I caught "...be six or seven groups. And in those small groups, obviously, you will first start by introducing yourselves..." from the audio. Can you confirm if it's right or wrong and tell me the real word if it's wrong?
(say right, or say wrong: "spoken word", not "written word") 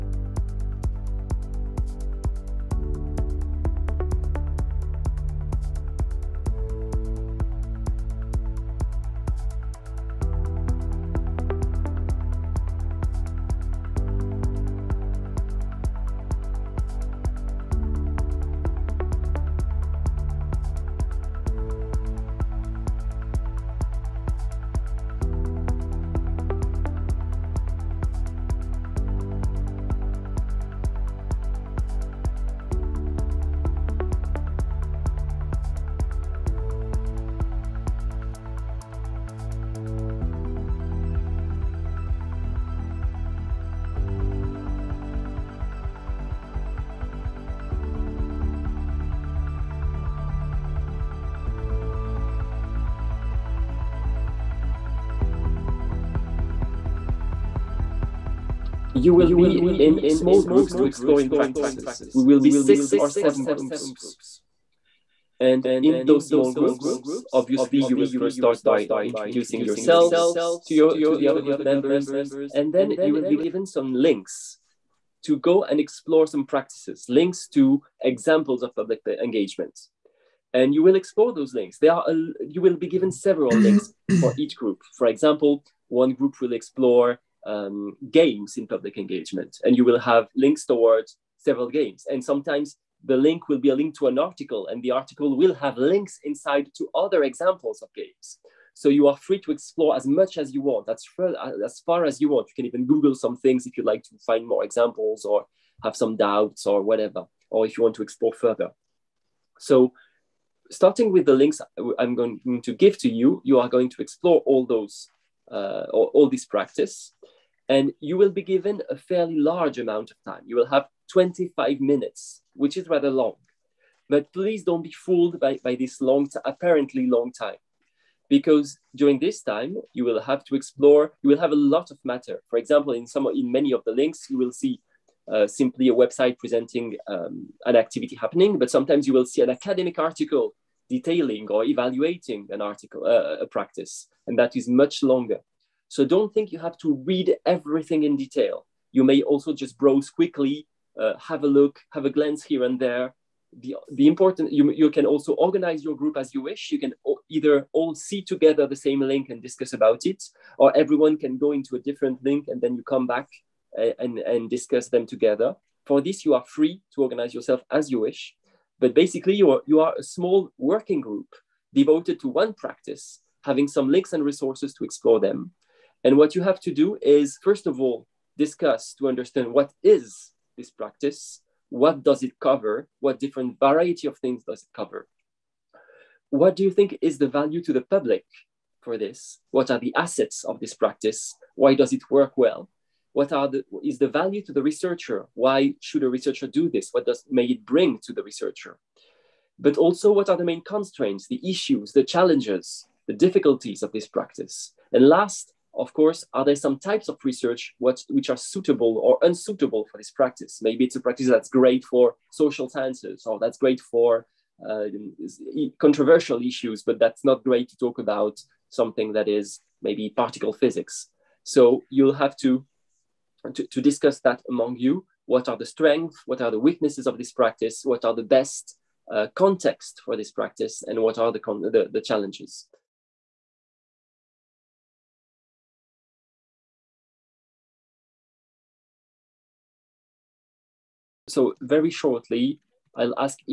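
right.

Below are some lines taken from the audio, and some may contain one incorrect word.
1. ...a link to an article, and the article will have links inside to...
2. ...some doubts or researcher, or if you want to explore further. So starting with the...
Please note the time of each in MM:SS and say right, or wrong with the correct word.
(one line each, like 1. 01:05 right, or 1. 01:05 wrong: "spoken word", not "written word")
1. 01:33 right
2. 01:45 wrong: "whatever", not "researcher".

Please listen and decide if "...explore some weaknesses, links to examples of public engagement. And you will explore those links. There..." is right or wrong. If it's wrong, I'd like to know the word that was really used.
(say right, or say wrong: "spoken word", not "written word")
wrong: "practices", not "weaknesses".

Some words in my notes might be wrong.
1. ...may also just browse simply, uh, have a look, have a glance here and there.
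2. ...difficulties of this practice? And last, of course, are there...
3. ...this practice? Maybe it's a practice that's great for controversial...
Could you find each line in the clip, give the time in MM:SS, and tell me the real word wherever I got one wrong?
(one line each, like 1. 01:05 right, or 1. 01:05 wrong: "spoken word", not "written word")
1. 02:29 wrong: "quickly", not "simply"
2. 03:23 right
3. 03:29 wrong: "social", not "controversial".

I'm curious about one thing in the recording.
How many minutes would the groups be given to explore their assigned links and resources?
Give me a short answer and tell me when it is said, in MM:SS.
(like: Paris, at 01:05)
25, at 02:01.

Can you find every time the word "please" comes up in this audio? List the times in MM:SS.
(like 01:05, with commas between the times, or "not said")
02:04.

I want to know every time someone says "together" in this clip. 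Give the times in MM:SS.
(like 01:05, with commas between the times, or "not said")
02:38, 02:45.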